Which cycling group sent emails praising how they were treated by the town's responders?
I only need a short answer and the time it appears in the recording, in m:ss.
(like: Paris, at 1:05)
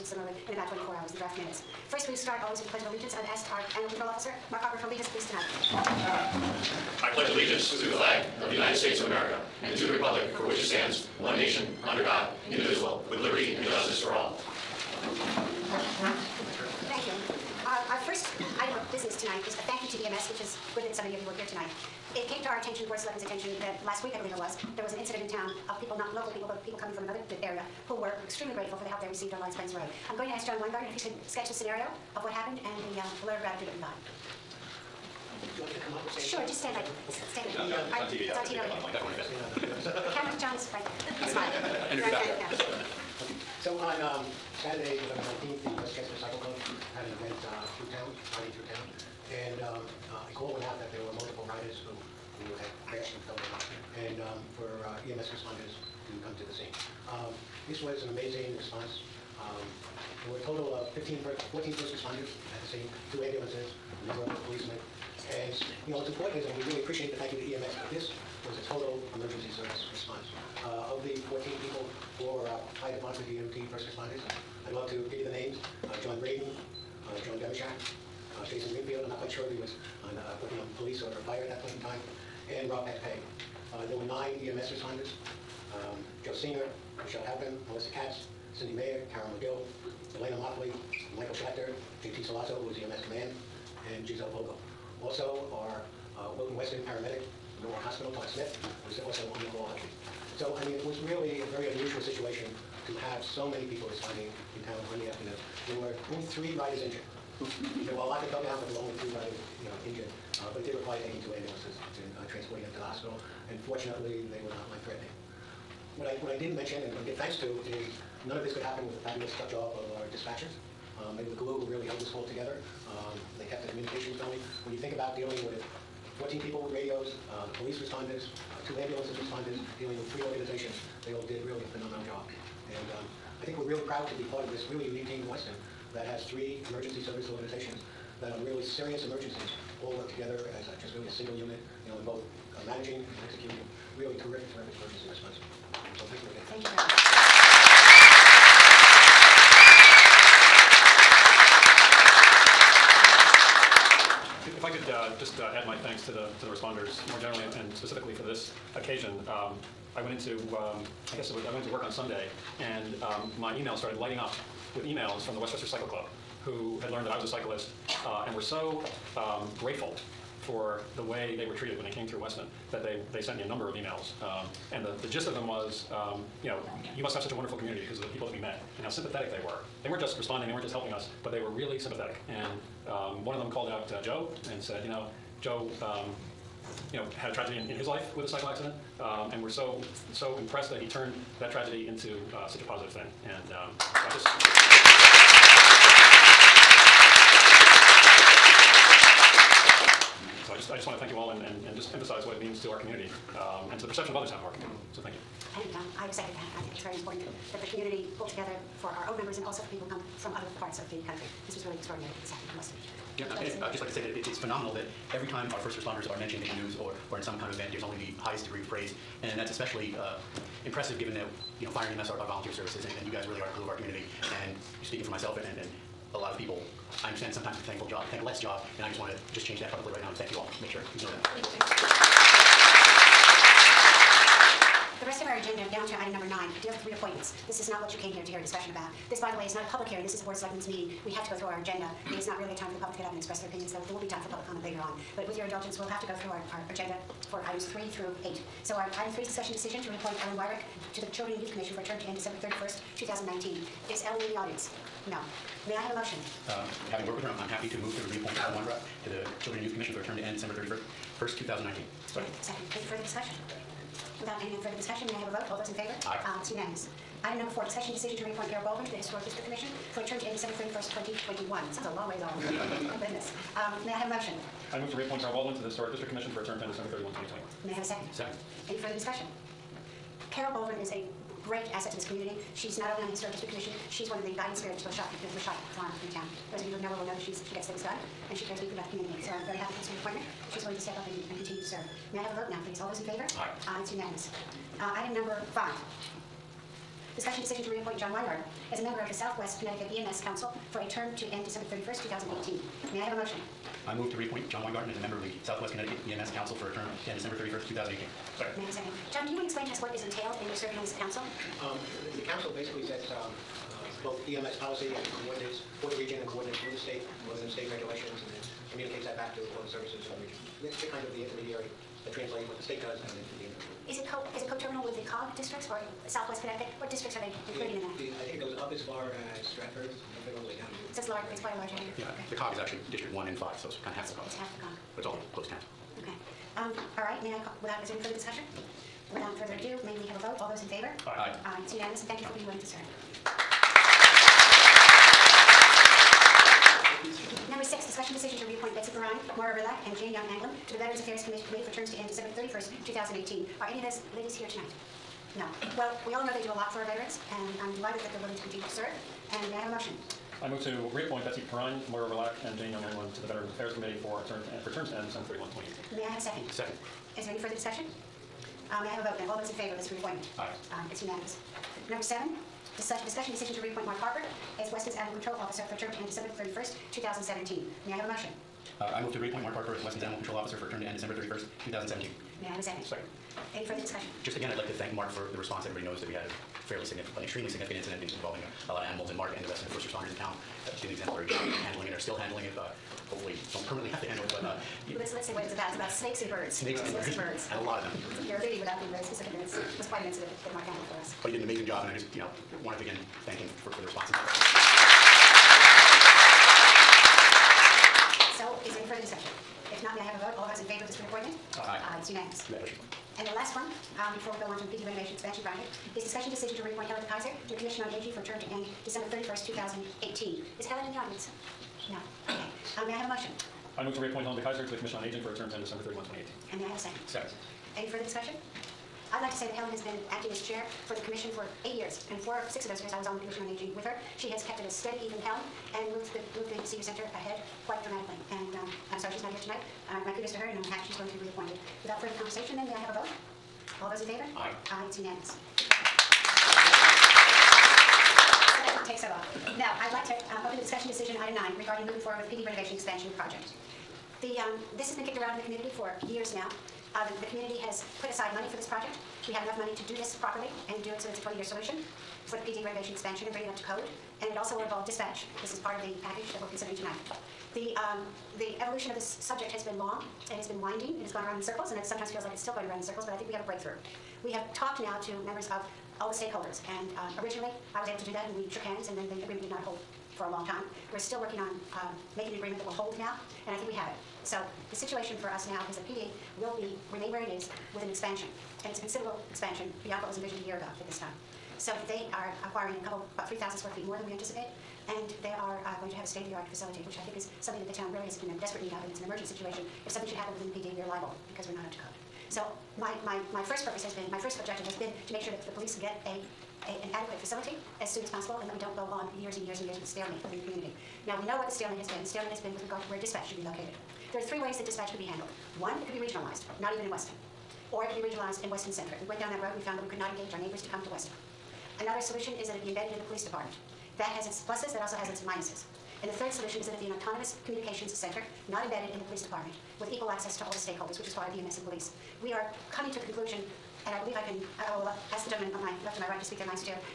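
Westchester Cycle Club, at 2:45.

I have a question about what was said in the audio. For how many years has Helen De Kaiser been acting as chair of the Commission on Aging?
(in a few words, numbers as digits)
8.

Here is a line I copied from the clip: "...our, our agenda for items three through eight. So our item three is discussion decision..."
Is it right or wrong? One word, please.
right.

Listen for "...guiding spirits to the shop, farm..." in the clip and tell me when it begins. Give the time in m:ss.
4:44.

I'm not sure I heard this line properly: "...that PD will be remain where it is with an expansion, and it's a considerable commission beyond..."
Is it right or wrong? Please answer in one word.
wrong.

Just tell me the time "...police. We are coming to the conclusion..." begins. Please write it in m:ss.
8:51.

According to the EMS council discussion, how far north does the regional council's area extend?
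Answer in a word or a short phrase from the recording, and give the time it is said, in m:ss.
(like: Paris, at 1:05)
Stratford, at 5:29.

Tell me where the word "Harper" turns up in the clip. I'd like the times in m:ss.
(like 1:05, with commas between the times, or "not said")
0:04, 6:13, 6:19.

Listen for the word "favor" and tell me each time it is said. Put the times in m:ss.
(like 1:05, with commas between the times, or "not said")
4:25, 4:53, 6:09, 6:50, 7:24.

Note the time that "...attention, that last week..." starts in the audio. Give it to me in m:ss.
0:23.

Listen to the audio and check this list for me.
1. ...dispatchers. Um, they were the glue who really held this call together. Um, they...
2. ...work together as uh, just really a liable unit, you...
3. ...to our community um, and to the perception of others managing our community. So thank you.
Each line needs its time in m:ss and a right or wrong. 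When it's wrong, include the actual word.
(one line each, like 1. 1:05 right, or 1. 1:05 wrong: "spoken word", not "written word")
1. 2:00 right
2. 2:19 wrong: "single", not "liable"
3. 3:22 wrong: "having", not "managing".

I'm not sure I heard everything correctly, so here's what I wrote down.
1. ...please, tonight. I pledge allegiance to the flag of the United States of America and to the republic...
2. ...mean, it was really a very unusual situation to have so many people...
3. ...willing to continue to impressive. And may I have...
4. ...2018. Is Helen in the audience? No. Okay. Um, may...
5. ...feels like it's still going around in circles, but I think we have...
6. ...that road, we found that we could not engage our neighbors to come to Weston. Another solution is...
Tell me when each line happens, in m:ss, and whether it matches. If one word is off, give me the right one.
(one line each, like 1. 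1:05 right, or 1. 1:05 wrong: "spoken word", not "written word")
1. 0:05 right
2. 1:40 right
3. 5:58 wrong: "serve", not "impressive"
4. 6:59 right
5. 7:52 right
6. 8:39 right.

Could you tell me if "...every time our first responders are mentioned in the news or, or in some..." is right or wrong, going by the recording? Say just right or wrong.
right.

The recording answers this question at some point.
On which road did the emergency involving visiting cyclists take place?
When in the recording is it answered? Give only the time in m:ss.
0:29.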